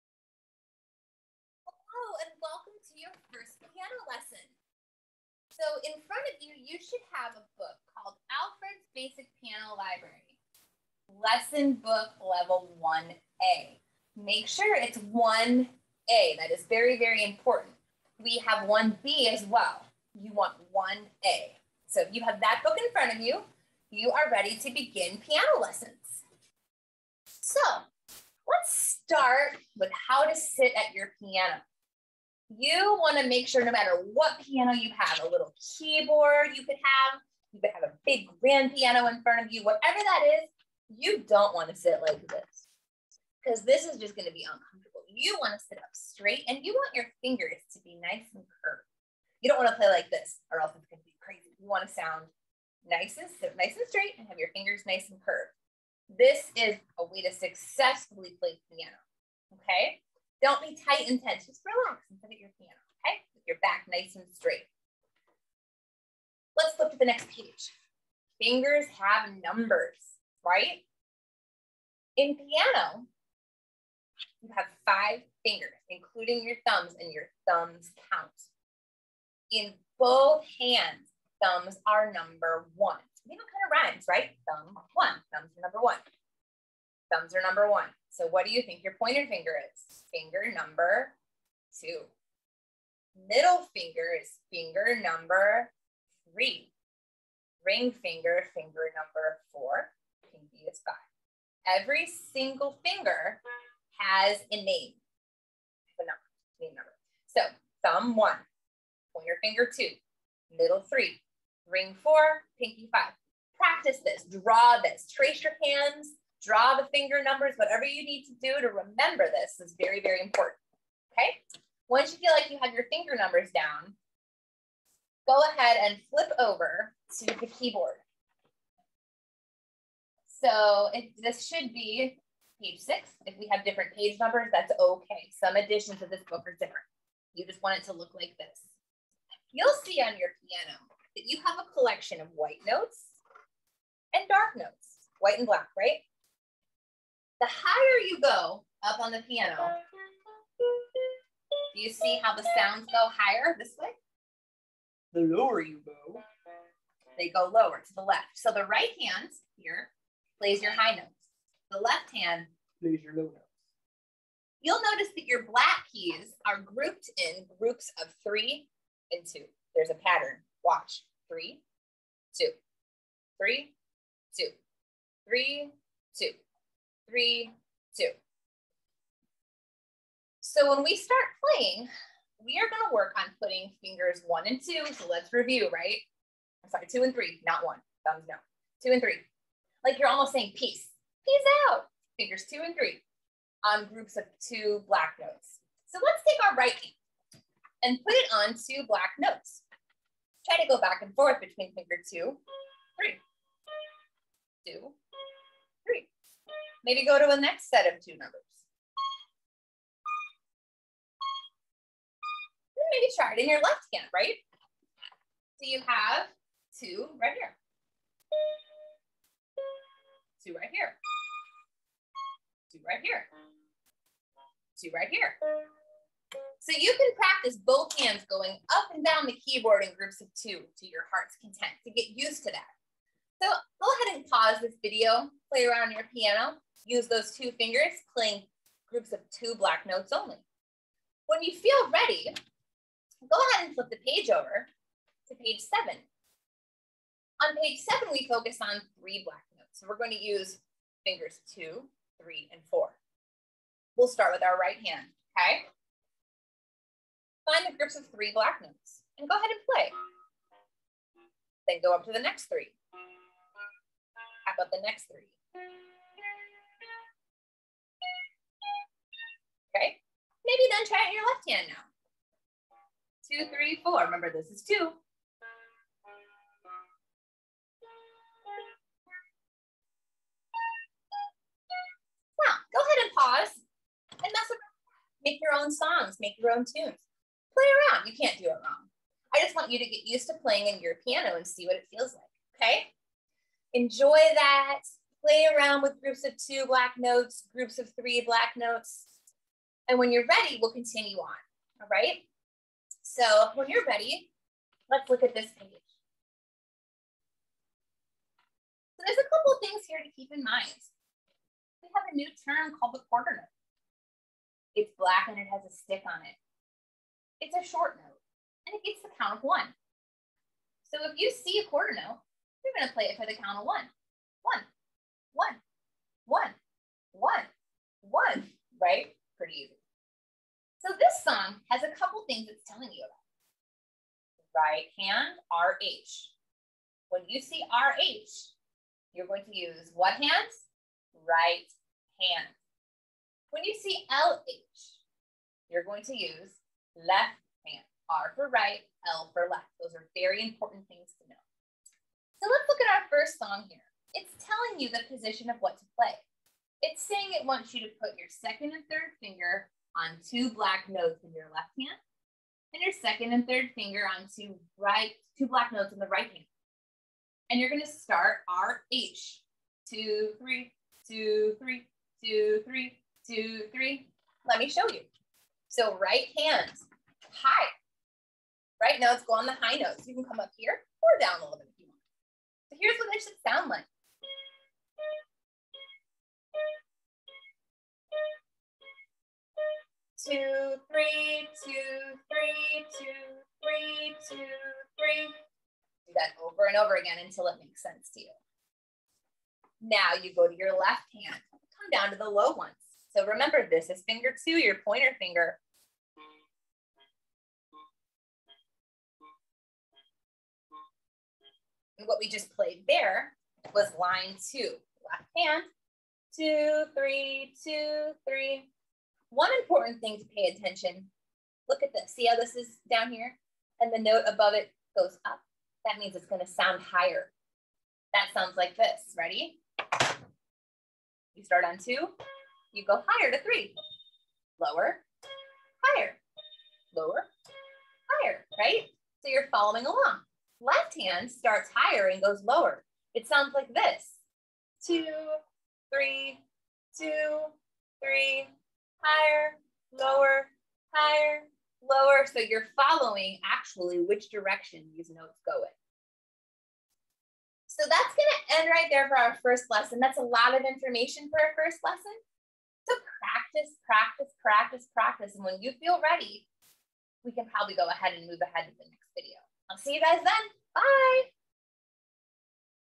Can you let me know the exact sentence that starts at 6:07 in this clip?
And you're gonna start our H.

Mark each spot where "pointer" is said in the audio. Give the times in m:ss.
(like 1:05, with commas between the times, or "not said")
1:28, 1:49, 6:44.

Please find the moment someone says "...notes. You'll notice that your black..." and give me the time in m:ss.
2:43.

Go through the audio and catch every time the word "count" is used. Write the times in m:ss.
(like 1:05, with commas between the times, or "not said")
1:18, 5:19, 5:23.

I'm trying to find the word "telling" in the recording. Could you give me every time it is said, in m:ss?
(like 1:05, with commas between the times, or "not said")
5:32, 5:54.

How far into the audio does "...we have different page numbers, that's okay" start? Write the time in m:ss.
2:13.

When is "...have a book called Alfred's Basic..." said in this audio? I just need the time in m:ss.
0:07.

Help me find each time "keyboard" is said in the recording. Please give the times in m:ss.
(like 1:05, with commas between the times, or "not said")
0:35, 2:07, 3:49.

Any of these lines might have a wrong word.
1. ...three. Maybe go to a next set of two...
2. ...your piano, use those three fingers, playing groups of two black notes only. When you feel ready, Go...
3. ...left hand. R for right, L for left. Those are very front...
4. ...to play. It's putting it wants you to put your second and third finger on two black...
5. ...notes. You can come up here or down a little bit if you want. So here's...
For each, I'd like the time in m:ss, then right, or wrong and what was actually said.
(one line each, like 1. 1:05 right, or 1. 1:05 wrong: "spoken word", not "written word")
1. 3:25 right
2. 3:55 wrong: "two", not "three"
3. 5:46 wrong: "important", not "front"
4. 5:55 wrong: "saying", not "putting"
5. 6:19 right.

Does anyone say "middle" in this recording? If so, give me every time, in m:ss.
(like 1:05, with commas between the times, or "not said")
1:33, 1:50.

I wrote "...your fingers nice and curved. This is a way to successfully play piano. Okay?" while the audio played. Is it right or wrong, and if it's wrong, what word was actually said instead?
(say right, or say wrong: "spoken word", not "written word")
right.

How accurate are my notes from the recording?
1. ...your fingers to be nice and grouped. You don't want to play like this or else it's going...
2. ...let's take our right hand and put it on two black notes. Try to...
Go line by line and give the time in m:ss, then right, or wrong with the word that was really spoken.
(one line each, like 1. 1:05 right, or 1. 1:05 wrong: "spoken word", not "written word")
1. 0:46 wrong: "curved", not "grouped"
2. 3:16 right.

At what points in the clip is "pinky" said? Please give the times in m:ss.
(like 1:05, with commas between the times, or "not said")
1:40, 1:52.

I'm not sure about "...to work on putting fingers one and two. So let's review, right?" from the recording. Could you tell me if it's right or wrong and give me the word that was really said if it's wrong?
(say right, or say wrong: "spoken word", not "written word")
right.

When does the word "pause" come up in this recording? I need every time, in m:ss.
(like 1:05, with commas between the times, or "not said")
3:54, 4:43.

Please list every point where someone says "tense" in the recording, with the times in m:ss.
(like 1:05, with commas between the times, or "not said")
1:01.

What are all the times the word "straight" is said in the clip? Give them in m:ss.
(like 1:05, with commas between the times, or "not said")
0:45, 0:53, 1:04.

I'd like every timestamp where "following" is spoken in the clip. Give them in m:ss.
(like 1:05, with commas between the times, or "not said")
7:19, 7:32.